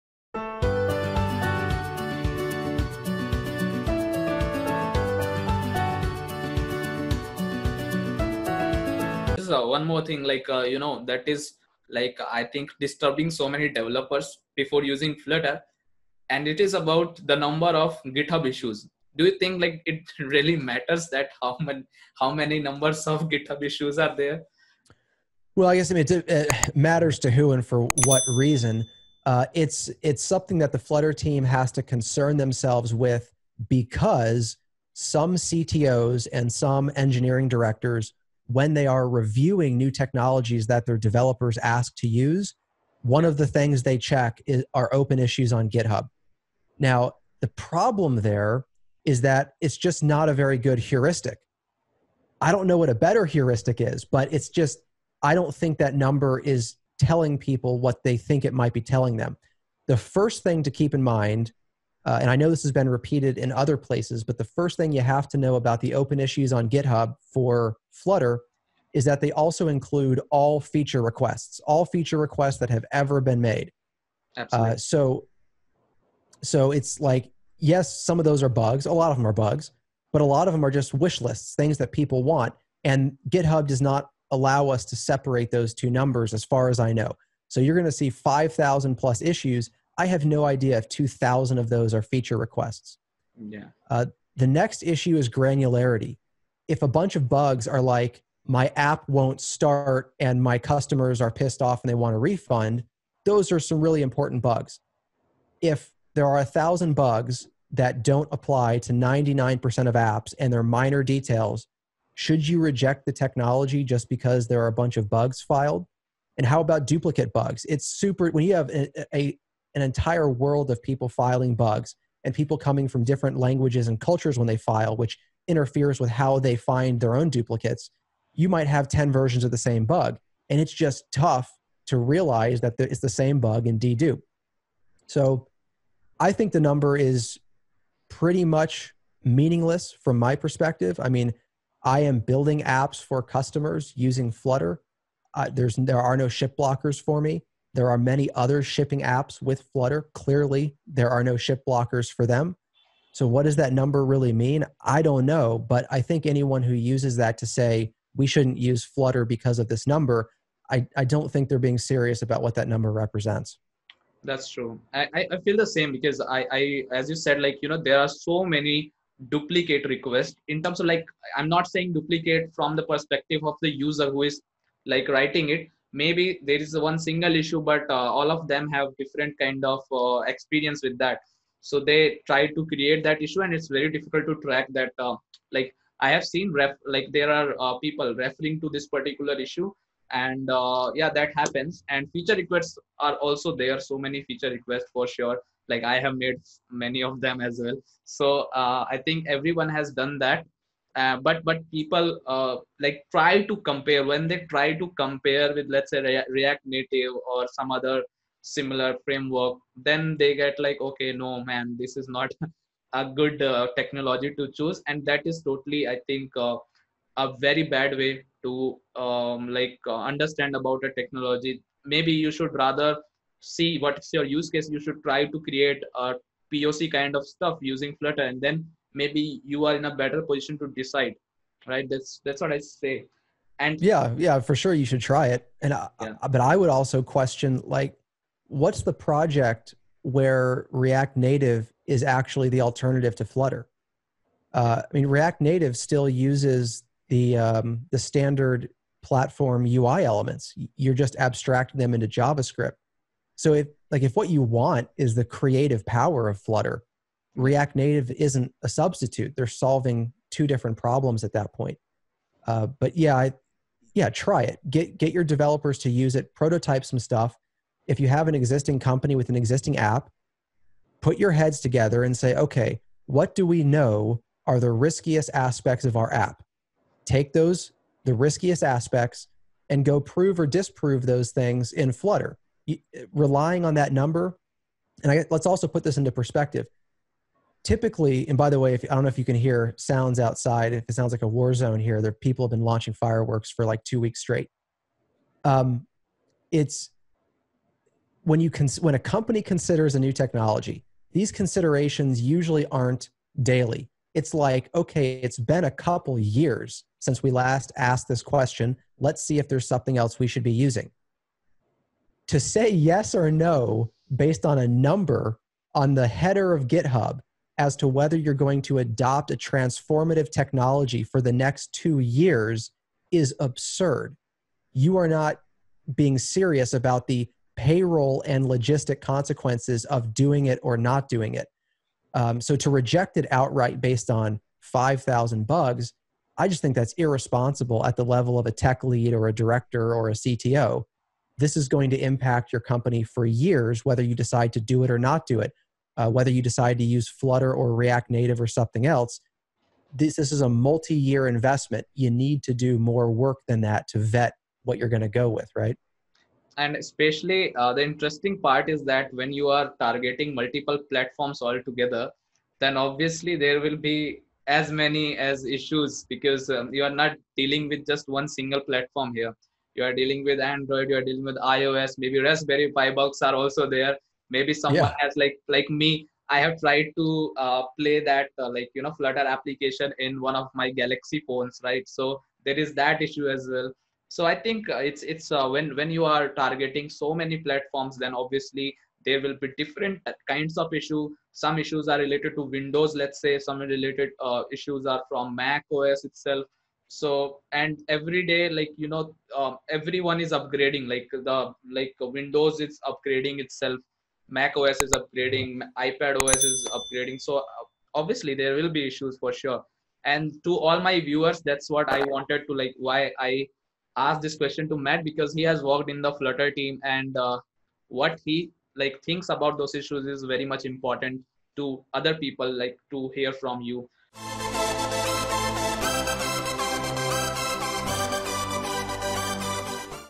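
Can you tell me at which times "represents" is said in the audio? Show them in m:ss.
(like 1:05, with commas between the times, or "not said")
2:42.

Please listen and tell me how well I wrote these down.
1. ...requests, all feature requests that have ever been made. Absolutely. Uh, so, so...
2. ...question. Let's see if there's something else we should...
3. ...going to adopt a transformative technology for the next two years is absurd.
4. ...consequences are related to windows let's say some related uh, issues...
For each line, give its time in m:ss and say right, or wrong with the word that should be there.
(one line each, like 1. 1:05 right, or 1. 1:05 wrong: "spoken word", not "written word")
1. 1:11 right
2. 5:08 right
3. 5:18 right
4. 6:31 wrong: "issues", not "consequences".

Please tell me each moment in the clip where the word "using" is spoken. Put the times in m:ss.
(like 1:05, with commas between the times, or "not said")
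0:14, 2:23, 3:47, 5:10.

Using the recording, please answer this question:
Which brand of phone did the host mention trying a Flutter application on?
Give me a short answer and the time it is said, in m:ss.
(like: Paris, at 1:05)
Galaxy, at 6:20.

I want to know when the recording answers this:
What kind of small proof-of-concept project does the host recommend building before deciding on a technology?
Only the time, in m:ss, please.
3:46.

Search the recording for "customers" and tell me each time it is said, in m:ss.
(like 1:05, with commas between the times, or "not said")
1:40, 2:23.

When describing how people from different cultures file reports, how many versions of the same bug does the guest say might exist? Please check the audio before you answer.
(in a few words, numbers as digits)
10.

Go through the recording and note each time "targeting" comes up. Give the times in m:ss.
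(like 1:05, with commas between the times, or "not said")
5:59, 6:26.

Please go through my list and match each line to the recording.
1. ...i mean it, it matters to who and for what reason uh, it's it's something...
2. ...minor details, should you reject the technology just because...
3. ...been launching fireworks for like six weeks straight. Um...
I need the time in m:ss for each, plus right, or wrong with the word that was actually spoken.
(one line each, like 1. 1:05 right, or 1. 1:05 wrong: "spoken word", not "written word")
1. 0:25 right
2. 1:50 right
3. 4:52 wrong: "two", not "six".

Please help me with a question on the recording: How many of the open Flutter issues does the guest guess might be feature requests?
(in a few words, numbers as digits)
2,000.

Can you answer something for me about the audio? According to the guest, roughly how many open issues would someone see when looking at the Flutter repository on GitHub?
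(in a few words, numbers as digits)
5,000.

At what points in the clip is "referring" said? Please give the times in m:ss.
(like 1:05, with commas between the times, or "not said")
3:08.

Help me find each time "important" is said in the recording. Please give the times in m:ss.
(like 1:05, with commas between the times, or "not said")
1:44, 7:00.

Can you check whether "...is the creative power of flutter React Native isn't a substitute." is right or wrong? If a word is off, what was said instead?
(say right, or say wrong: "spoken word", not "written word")
right.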